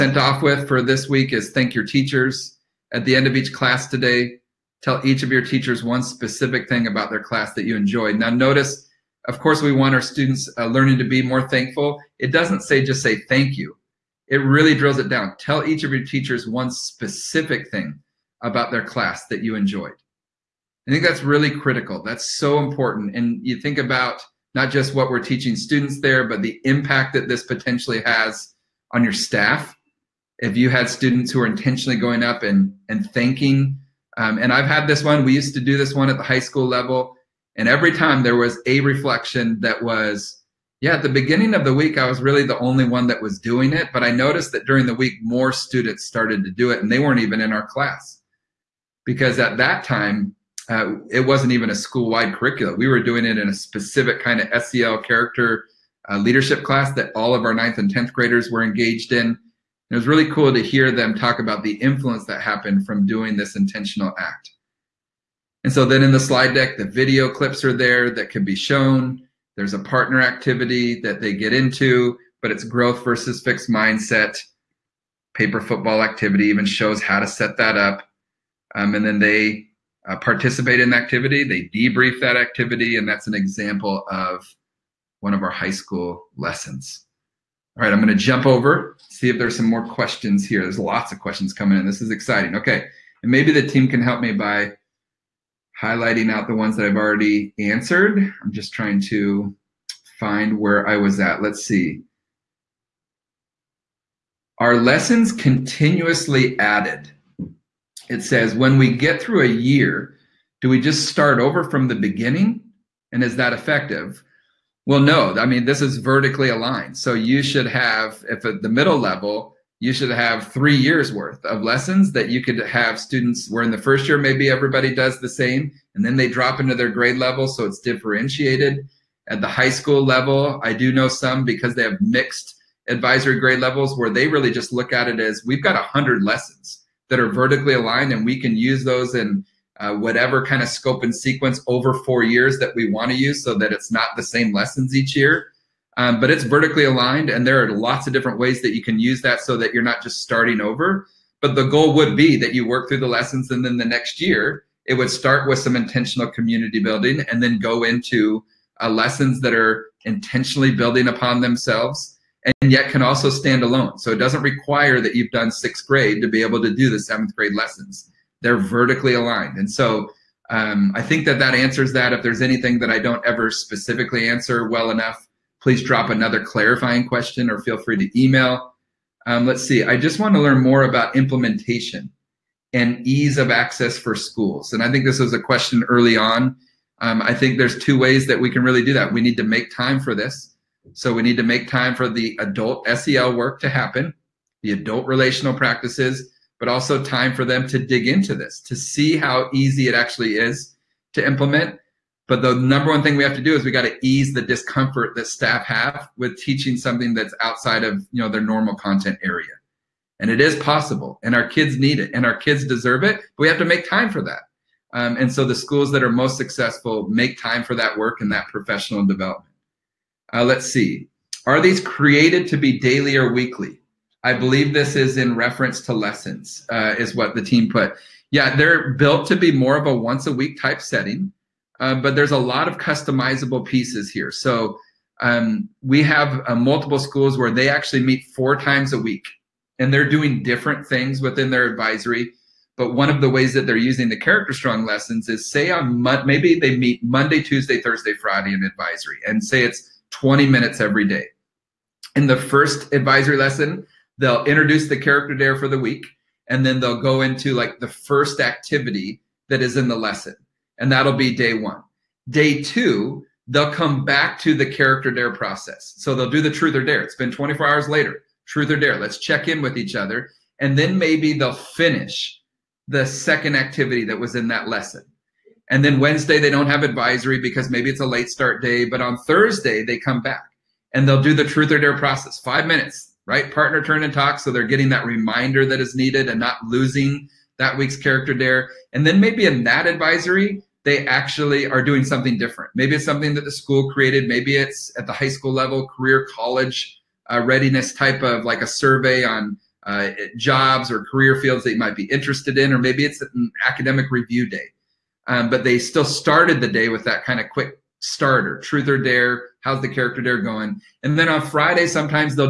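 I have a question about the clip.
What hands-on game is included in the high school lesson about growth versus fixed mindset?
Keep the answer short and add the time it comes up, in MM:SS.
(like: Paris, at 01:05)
Paper football, at 01:15.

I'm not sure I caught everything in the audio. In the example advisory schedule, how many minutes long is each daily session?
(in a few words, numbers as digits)
20.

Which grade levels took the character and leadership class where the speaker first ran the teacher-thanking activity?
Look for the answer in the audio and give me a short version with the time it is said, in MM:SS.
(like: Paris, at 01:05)
9th and 10th, at 00:57.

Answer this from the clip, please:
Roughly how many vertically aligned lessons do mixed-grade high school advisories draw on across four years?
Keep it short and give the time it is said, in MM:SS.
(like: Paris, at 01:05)
100, at 02:15.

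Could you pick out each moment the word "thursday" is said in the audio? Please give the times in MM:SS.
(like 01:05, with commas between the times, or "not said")
04:07, 04:39.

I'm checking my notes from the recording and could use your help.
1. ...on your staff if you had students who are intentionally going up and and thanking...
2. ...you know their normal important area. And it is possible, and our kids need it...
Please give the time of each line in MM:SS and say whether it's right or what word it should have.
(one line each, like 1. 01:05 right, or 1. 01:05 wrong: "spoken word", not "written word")
1. 00:28 right
2. 03:28 wrong: "content", not "important".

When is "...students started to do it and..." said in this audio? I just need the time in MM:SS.
00:45.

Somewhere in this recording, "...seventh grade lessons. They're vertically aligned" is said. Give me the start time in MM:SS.
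02:46.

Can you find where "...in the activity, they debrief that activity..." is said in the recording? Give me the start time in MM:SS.
01:20.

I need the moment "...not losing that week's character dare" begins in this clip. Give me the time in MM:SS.
04:46.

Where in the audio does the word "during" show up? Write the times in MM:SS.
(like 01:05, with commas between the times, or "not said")
00:44.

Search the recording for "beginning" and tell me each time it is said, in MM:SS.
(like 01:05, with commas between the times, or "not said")
00:41, 01:51.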